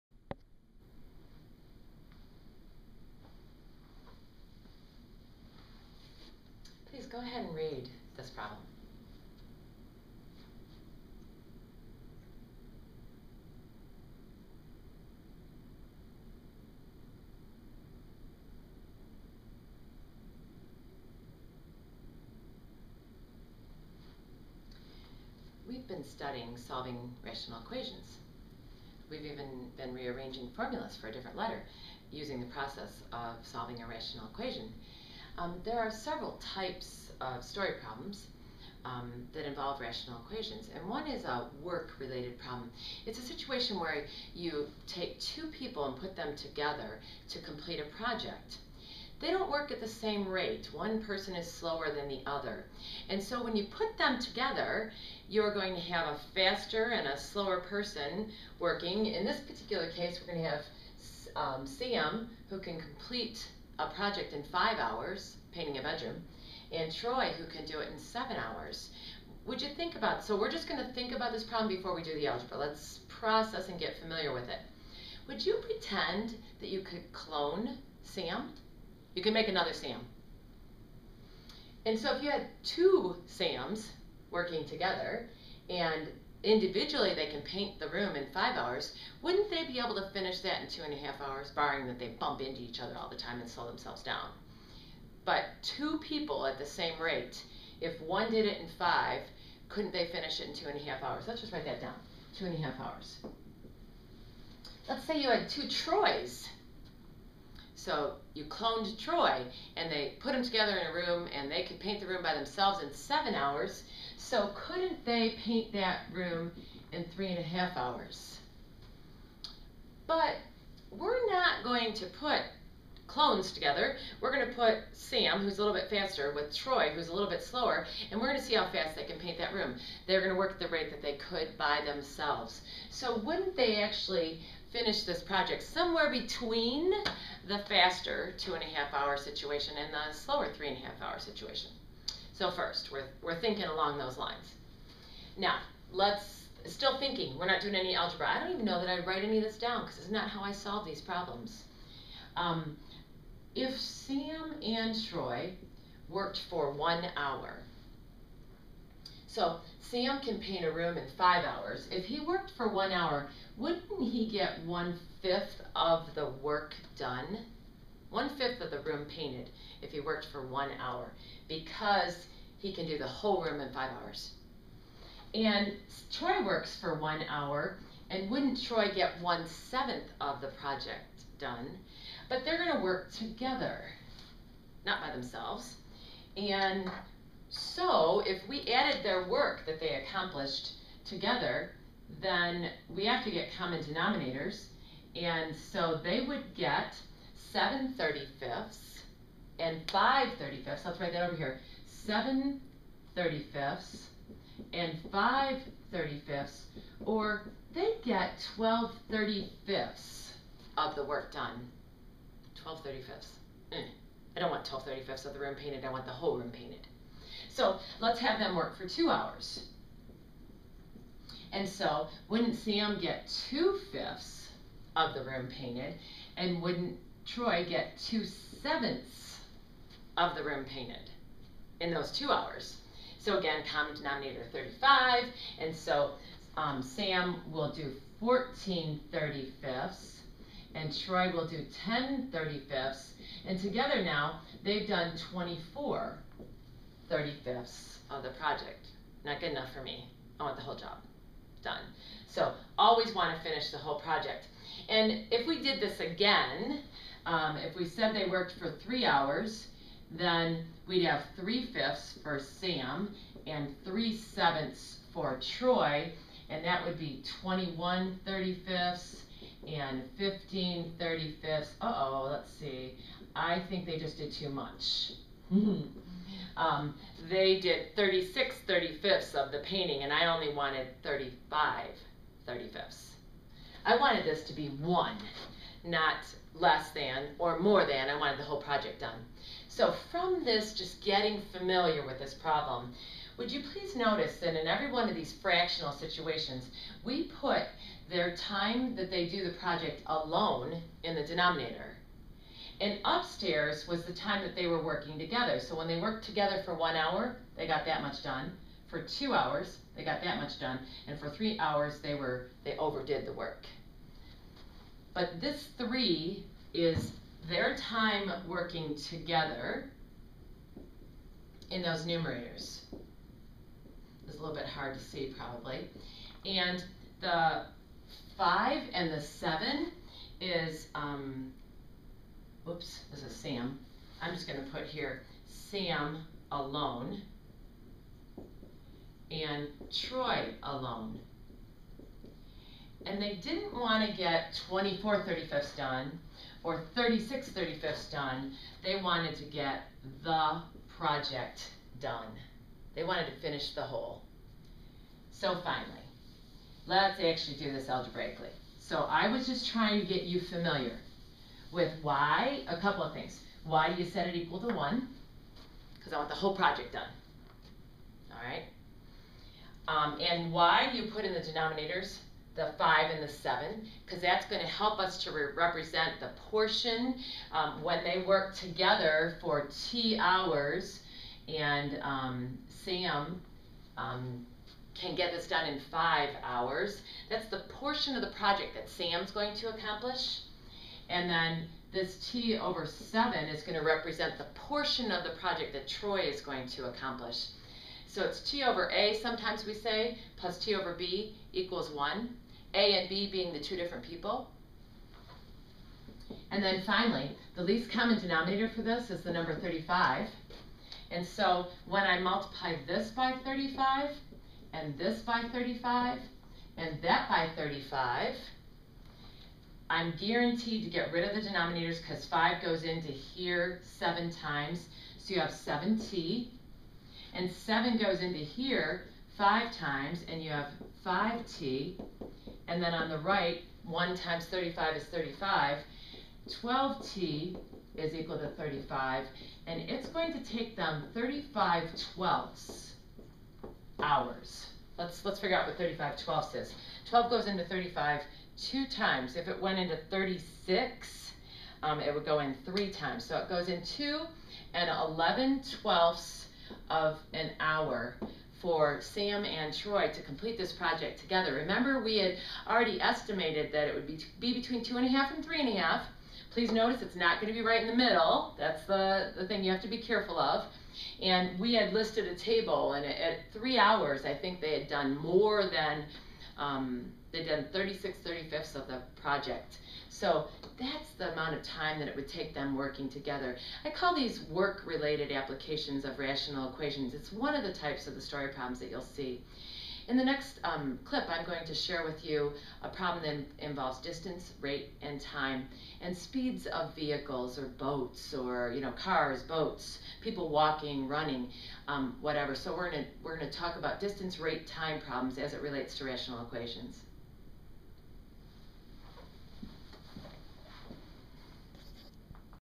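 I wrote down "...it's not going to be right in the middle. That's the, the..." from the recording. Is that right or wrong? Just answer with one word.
right.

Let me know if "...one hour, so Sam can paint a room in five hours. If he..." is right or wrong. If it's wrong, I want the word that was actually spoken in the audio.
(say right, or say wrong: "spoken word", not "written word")
right.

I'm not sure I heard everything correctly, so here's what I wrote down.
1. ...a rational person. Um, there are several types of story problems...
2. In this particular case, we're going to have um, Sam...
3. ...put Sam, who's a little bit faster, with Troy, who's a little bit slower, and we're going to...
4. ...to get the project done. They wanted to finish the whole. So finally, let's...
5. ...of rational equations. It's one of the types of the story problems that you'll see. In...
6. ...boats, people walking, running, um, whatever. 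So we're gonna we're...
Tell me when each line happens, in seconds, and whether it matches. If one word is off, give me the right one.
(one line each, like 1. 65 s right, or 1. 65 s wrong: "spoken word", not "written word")
1. 33 s wrong: "equation", not "person"
2. 59 s right
3. 124 s right
4. 349 s right
5. 486 s right
6. 499 s right.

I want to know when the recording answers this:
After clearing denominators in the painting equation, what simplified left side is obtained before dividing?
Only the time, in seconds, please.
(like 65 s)
436 s.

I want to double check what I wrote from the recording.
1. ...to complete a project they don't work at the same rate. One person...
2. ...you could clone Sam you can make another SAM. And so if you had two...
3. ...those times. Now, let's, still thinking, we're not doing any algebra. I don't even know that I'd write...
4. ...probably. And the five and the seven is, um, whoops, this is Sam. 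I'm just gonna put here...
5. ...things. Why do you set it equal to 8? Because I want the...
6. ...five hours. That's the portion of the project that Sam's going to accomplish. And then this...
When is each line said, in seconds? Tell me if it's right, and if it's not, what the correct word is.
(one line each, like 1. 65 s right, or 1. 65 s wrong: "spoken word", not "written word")
1. 47 s right
2. 76 s right
3. 143 s wrong: "lines", not "times"
4. 325 s right
5. 363 s wrong: "1", not "8"
6. 385 s right.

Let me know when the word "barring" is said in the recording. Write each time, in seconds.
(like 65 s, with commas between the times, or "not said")
91 s.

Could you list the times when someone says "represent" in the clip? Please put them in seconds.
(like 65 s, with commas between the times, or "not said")
375 s, 393 s.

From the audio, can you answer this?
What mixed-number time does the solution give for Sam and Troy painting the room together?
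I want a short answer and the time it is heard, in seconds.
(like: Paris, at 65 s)
2 11/12 hours, at 453 s.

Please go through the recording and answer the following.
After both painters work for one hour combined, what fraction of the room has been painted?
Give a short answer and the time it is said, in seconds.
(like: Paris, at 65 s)
12/35, at 208 s.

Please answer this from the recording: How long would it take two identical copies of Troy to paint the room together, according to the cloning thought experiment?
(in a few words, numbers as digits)
3.5 hours.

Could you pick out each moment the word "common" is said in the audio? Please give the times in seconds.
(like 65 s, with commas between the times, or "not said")
193 s, 233 s, 407 s.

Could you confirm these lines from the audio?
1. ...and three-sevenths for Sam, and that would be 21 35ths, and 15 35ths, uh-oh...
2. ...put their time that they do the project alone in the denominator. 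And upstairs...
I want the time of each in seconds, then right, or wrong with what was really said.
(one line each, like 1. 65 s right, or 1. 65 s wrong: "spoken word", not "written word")
1. 263 s wrong: "Troy", not "Sam"
2. 297 s right.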